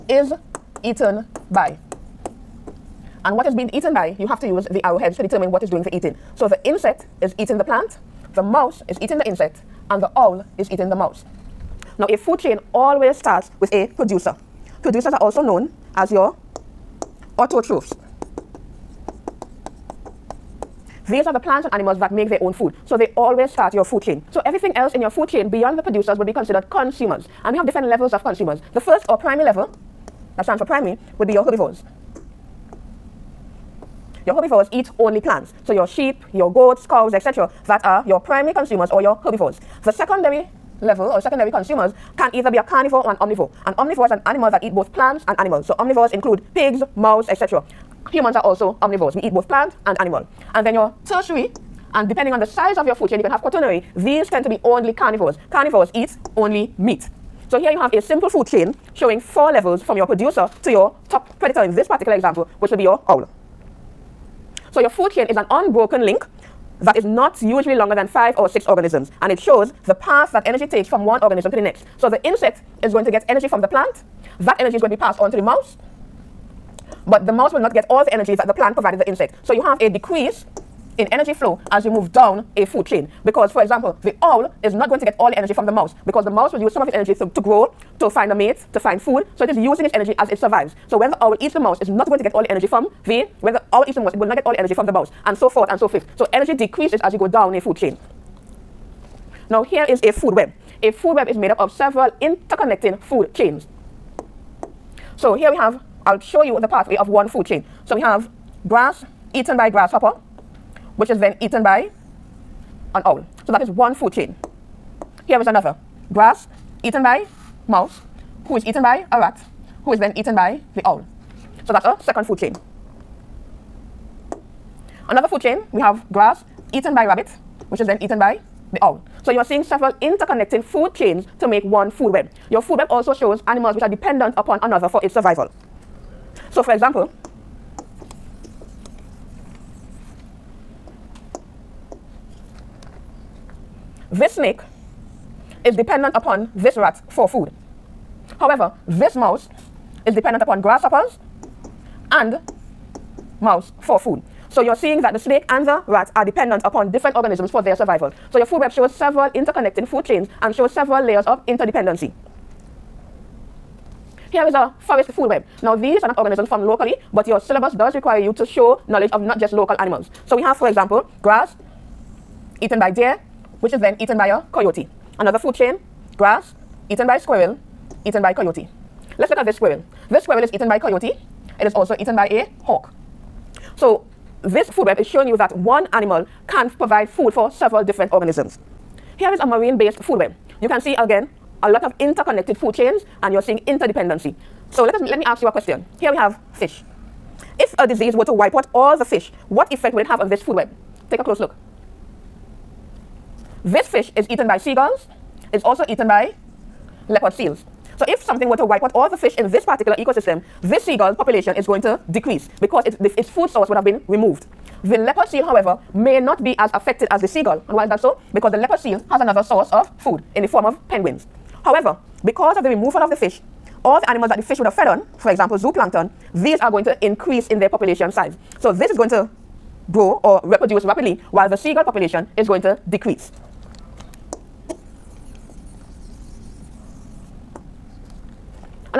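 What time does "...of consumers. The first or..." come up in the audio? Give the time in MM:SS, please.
00:28.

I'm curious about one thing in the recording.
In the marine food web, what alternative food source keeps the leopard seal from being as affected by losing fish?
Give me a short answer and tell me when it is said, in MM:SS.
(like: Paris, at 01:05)
Penguins, at 03:40.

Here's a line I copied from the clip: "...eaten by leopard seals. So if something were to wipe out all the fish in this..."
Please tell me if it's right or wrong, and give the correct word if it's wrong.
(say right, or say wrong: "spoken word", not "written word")
right.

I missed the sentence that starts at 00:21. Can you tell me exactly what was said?
These are the plants and animals that make their own food.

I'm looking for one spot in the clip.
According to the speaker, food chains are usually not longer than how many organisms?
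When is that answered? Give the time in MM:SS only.
01:08.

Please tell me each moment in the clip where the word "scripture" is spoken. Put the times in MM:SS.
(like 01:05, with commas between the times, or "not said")
not said.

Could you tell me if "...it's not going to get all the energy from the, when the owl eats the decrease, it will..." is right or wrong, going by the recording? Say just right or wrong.
wrong.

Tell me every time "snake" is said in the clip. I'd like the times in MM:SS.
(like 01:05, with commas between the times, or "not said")
02:24, 02:35.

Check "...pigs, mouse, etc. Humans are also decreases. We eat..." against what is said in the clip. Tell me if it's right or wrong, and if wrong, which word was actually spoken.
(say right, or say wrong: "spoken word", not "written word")
wrong: "omnivores", not "decreases".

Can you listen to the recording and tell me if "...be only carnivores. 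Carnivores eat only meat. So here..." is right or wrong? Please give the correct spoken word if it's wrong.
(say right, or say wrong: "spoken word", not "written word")
right.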